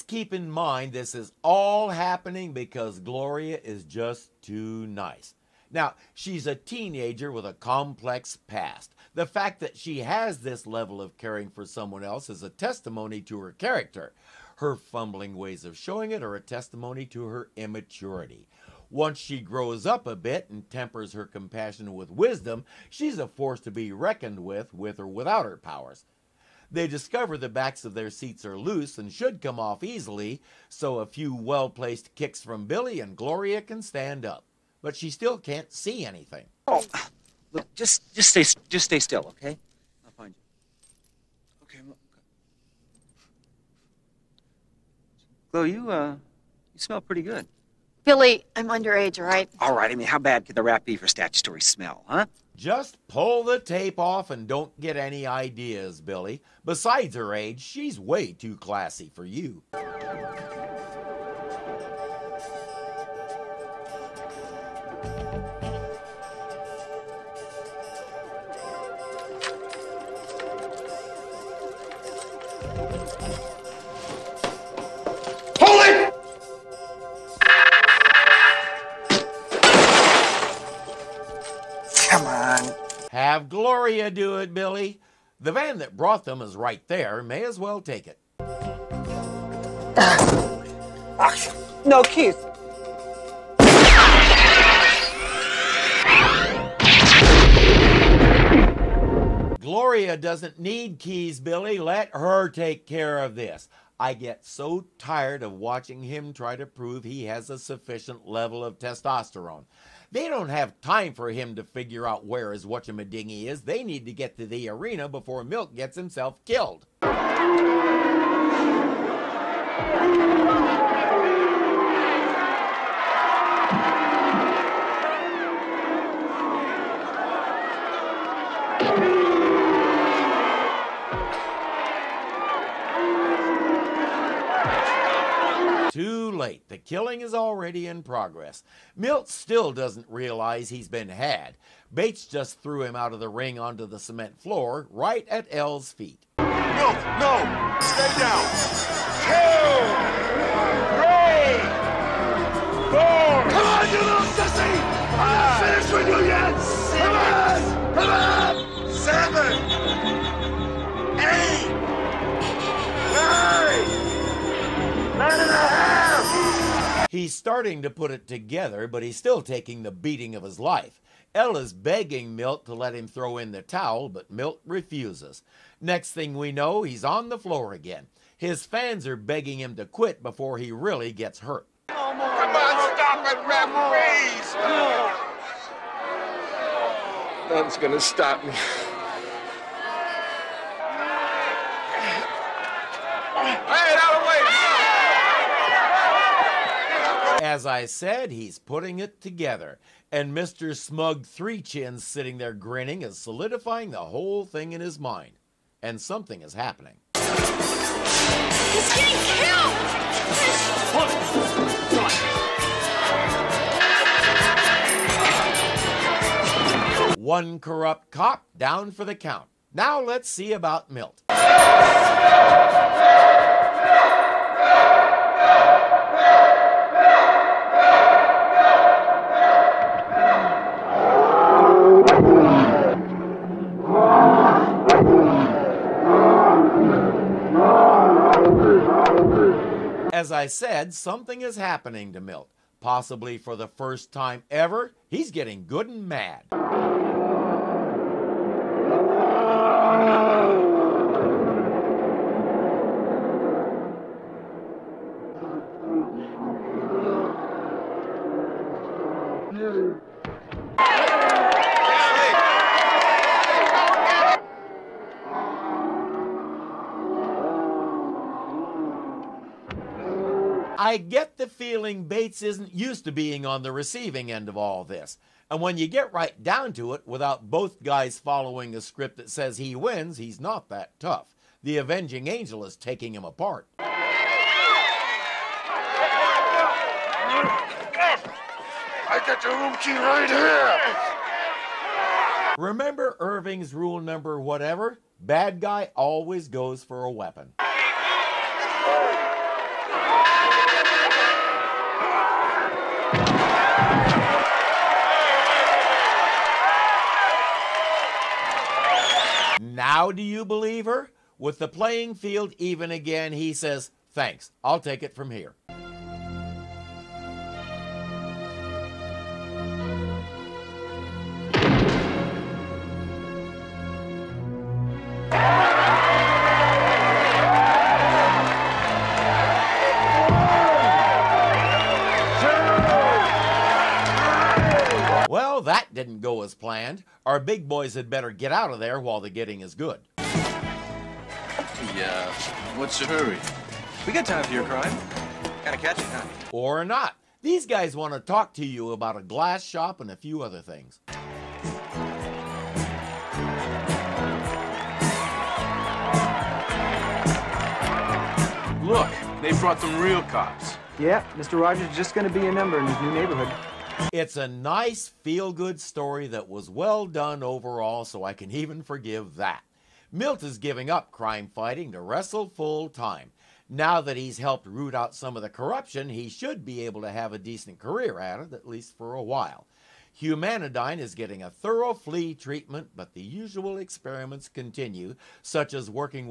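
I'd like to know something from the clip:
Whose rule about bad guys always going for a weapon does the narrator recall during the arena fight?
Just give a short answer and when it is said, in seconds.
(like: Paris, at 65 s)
Irving, at 293 s.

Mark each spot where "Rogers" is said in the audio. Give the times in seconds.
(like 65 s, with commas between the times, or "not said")
361 s.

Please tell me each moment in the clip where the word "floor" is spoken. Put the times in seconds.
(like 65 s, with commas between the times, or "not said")
144 s, 177 s.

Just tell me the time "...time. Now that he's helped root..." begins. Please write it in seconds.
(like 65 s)
372 s.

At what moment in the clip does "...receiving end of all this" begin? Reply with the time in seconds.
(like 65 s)
273 s.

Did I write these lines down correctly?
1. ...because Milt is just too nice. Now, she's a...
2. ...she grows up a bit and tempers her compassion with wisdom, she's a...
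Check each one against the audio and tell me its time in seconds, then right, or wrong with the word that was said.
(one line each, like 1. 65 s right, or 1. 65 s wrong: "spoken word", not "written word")
1. 2 s wrong: "Gloria", not "Milt"
2. 19 s right.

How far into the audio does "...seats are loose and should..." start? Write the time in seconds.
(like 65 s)
28 s.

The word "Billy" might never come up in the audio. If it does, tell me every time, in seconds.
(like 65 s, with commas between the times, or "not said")
32 s, 48 s, 56 s, 84 s, 101 s.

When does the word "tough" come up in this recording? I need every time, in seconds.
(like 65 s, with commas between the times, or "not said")
280 s.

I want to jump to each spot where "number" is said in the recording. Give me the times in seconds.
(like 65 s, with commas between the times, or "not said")
293 s, 362 s.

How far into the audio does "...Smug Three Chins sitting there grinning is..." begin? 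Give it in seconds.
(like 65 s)
200 s.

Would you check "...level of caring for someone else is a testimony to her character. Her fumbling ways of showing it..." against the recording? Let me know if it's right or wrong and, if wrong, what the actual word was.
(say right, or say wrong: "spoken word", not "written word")
right.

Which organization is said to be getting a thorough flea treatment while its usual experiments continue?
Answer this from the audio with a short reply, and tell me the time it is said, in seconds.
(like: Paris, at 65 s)
Humanidyne, at 380 s.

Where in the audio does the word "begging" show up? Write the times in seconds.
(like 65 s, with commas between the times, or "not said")
171 s, 179 s.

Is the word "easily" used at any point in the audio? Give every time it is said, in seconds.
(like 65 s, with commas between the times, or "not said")
29 s.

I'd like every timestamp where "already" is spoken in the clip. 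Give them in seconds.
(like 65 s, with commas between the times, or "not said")
137 s.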